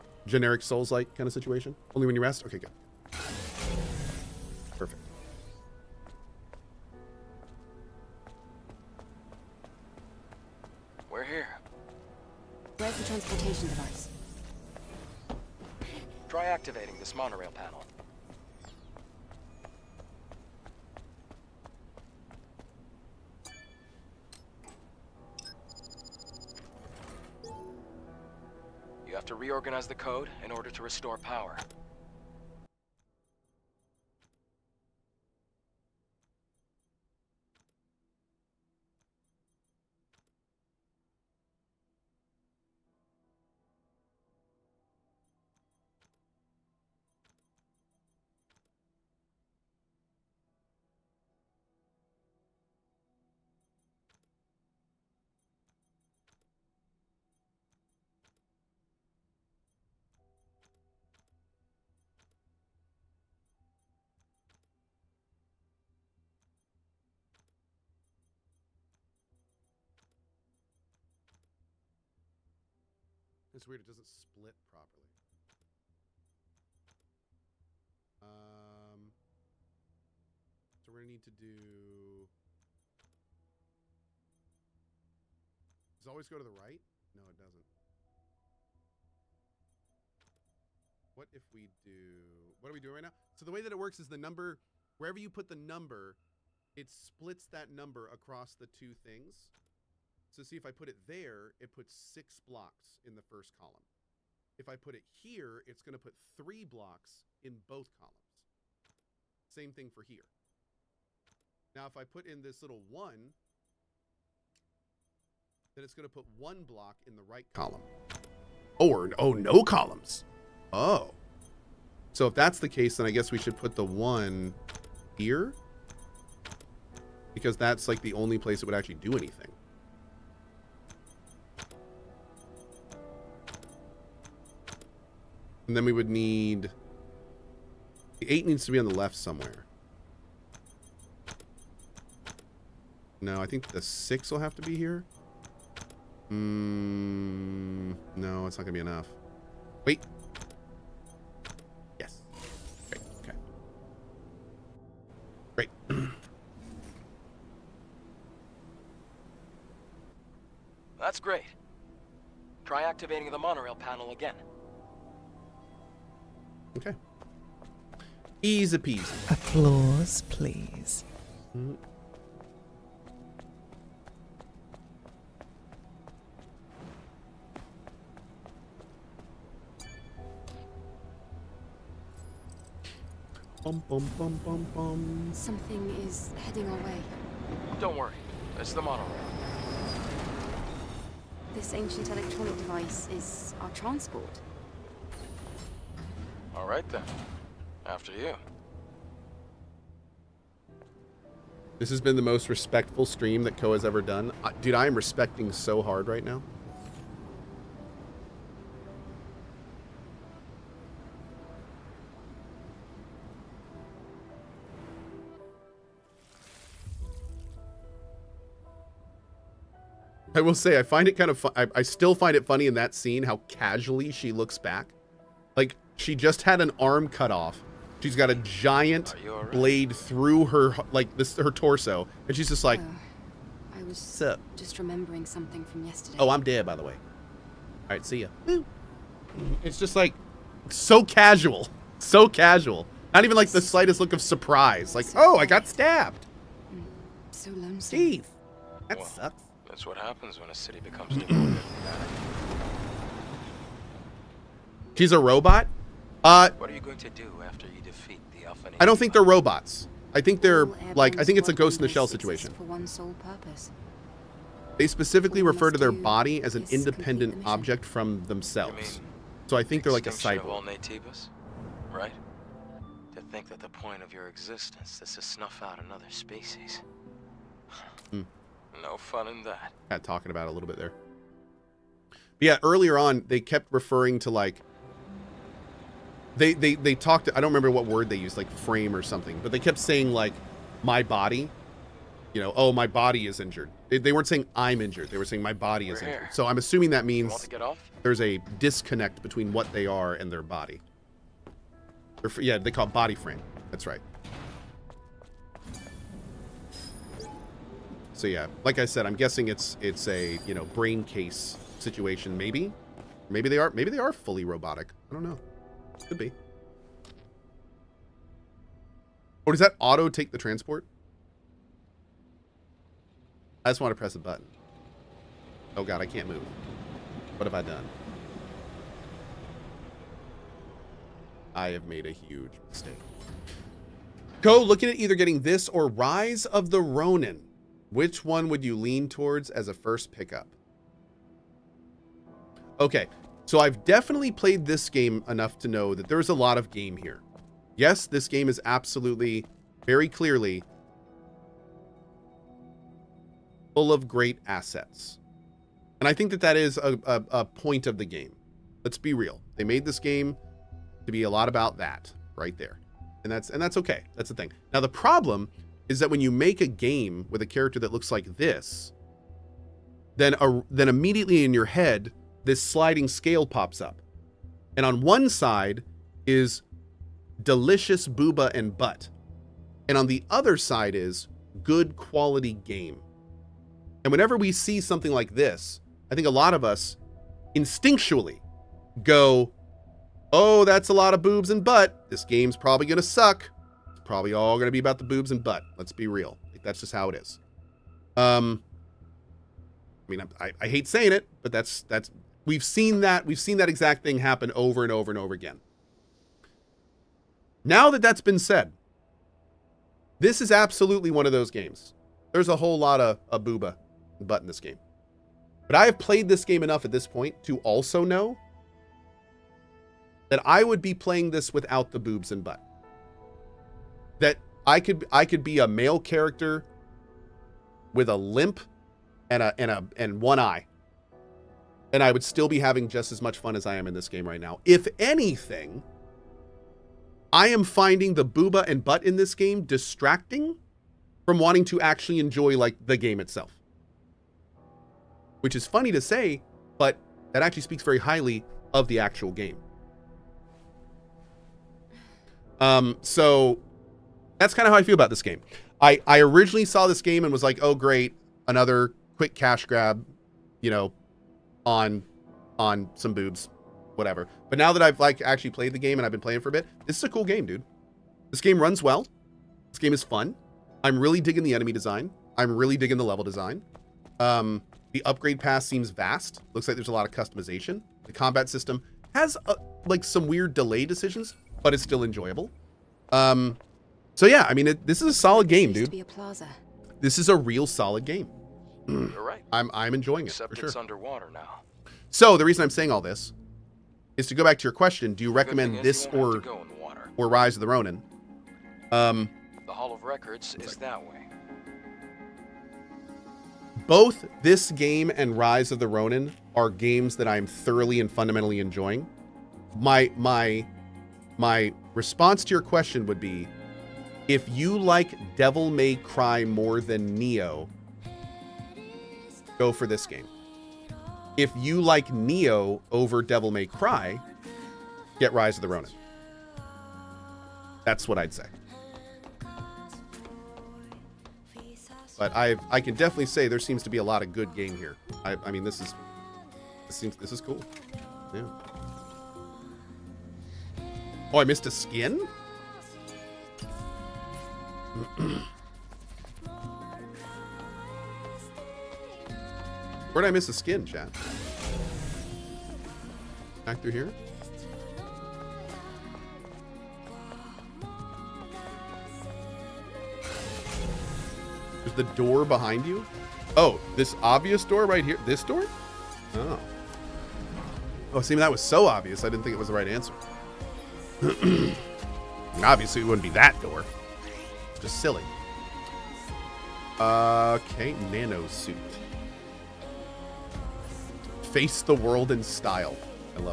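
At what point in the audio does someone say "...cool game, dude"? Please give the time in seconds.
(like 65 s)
467 s.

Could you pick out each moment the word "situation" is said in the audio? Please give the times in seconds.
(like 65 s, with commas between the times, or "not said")
1 s, 262 s, 311 s.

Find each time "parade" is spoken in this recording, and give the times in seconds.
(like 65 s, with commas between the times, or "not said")
not said.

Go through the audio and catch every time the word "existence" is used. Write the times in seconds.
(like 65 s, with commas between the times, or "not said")
274 s.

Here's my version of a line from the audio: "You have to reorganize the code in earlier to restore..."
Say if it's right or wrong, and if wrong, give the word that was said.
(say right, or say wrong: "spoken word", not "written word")
wrong: "order", not "earlier".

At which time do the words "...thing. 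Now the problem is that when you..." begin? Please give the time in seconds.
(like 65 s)
364 s.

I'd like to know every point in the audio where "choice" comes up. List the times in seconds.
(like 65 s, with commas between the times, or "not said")
not said.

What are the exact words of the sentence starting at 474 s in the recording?
Um, the upgrade pass seems vast.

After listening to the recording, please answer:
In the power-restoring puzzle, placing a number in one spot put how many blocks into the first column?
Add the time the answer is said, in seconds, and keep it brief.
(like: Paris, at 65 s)
6, at 101 s.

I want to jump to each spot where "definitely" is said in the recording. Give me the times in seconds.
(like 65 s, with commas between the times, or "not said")
343 s, 532 s.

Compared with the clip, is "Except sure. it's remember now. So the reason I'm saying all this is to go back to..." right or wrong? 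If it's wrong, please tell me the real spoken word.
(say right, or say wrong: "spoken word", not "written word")
wrong: "underwater", not "remember".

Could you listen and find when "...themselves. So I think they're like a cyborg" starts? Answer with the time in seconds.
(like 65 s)
268 s.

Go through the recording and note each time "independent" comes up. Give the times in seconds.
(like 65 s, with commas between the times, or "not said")
266 s.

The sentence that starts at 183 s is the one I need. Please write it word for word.
Bum, bum, bum, Something is heading our way.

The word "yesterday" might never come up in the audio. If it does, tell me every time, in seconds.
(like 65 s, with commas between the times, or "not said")
235 s.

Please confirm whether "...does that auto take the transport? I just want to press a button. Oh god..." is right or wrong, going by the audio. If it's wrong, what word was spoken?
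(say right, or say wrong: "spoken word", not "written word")
right.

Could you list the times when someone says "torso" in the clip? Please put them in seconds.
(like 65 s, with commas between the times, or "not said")
231 s.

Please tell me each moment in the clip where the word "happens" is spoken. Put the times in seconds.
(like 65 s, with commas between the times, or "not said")
249 s, 404 s.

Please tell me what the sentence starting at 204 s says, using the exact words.
I, dude, I am respecting so hard right now.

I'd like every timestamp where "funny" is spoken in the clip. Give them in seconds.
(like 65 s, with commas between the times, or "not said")
222 s, 445 s.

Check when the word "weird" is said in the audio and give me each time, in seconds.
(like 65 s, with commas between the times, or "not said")
73 s, 480 s.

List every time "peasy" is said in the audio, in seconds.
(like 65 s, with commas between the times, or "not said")
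168 s.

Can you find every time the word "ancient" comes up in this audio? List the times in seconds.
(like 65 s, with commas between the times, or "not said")
191 s.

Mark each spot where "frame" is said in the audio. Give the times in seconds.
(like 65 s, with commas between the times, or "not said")
288 s, 303 s.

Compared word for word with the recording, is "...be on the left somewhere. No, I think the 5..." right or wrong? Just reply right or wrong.
wrong.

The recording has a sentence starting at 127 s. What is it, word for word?
Because that's like the only place it would actually do anything.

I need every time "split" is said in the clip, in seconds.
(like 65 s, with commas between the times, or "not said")
74 s, 96 s.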